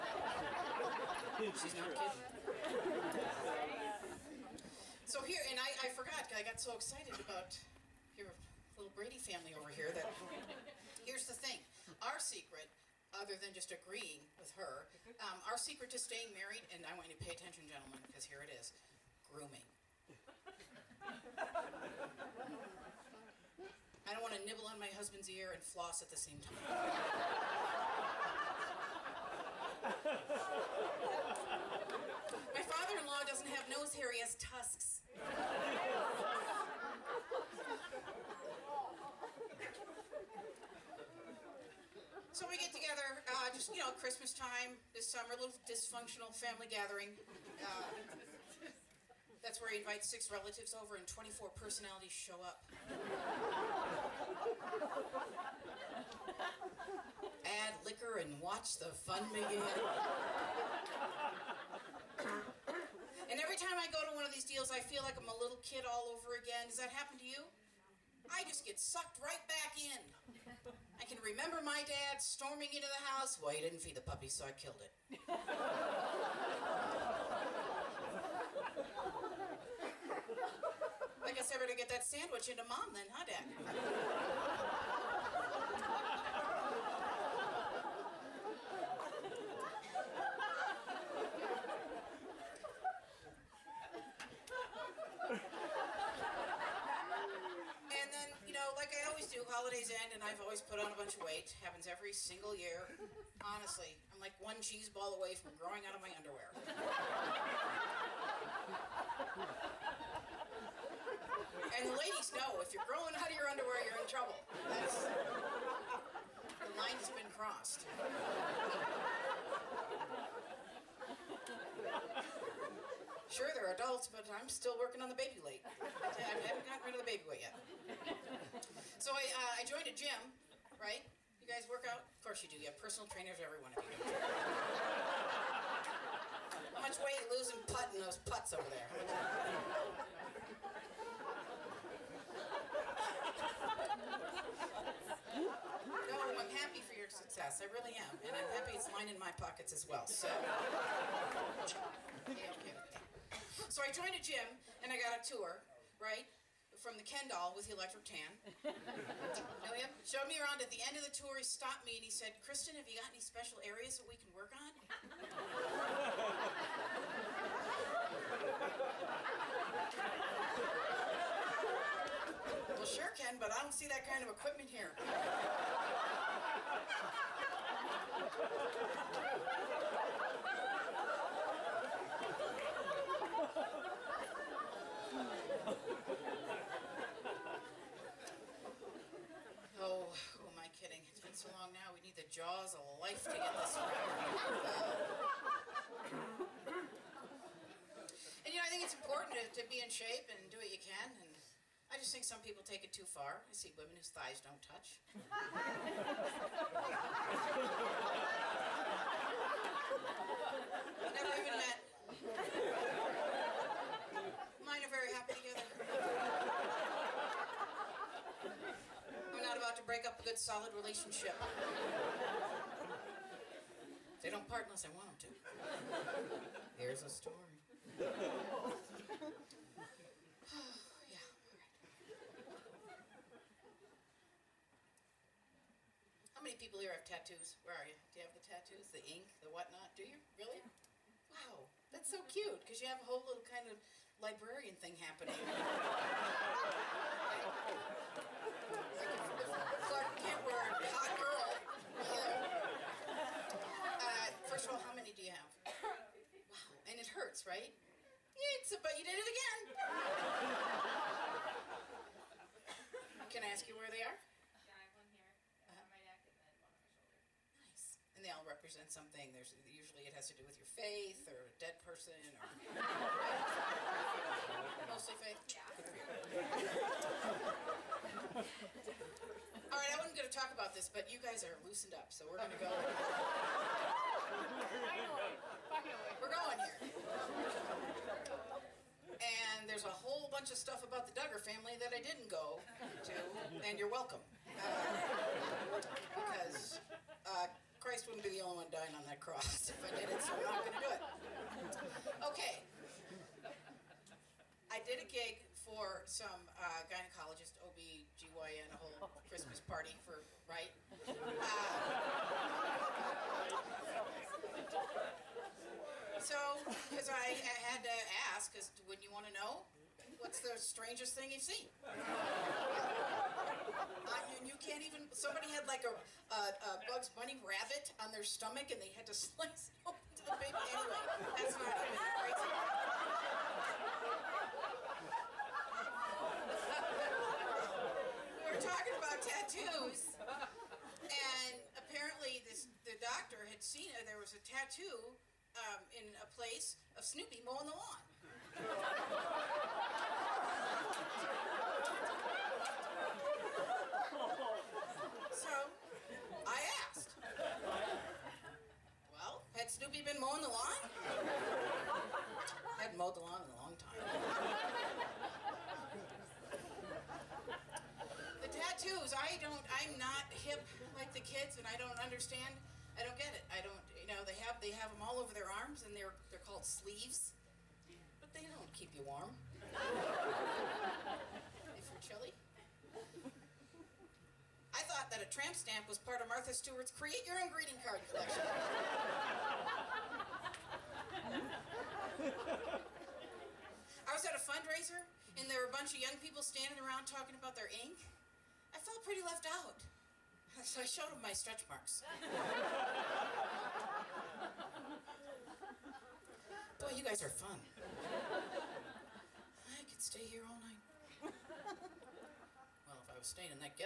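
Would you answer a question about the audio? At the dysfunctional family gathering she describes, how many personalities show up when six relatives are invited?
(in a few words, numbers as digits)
24.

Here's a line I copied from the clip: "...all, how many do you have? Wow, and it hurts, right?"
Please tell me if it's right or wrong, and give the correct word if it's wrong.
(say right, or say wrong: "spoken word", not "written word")
right.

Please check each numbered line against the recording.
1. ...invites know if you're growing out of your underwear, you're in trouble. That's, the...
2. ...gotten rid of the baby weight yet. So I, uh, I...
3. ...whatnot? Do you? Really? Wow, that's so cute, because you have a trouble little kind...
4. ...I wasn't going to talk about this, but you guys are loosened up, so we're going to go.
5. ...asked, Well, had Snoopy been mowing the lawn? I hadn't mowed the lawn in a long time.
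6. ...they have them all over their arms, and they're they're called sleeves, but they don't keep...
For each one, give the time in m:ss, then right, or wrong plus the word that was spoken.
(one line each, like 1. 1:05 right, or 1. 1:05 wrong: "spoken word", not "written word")
1. 1:51 wrong: "ladies", not "invites"
2. 2:06 right
3. 3:59 wrong: "whole", not "trouble"
4. 4:39 right
5. 5:56 right
6. 6:14 right.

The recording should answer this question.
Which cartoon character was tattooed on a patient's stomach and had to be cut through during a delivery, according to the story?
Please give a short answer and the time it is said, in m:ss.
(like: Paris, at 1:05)
Bugs Bunny, at 5:26.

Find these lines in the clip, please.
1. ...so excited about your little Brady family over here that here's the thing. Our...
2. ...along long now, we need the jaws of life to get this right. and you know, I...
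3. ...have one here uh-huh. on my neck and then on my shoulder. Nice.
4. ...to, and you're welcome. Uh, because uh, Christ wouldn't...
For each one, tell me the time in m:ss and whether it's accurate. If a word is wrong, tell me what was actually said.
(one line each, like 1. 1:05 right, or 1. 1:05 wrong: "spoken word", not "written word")
1. 0:06 right
2. 3:11 right
3. 4:24 right
4. 4:53 right.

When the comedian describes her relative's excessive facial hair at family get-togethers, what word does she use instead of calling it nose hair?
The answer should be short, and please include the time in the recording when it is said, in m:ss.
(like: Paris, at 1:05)
Tusks, at 0:34.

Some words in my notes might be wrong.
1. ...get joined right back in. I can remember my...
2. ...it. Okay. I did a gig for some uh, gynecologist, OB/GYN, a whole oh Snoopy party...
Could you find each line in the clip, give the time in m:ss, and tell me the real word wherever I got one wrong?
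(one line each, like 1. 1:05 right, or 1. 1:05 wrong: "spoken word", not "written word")
1. 1:08 wrong: "sucked", not "joined"
2. 5:02 wrong: "Christmas", not "Snoopy".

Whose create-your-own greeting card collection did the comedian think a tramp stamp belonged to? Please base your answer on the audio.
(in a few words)
Martha Stewart.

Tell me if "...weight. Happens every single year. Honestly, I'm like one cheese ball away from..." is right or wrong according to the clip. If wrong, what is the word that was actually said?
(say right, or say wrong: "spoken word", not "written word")
right.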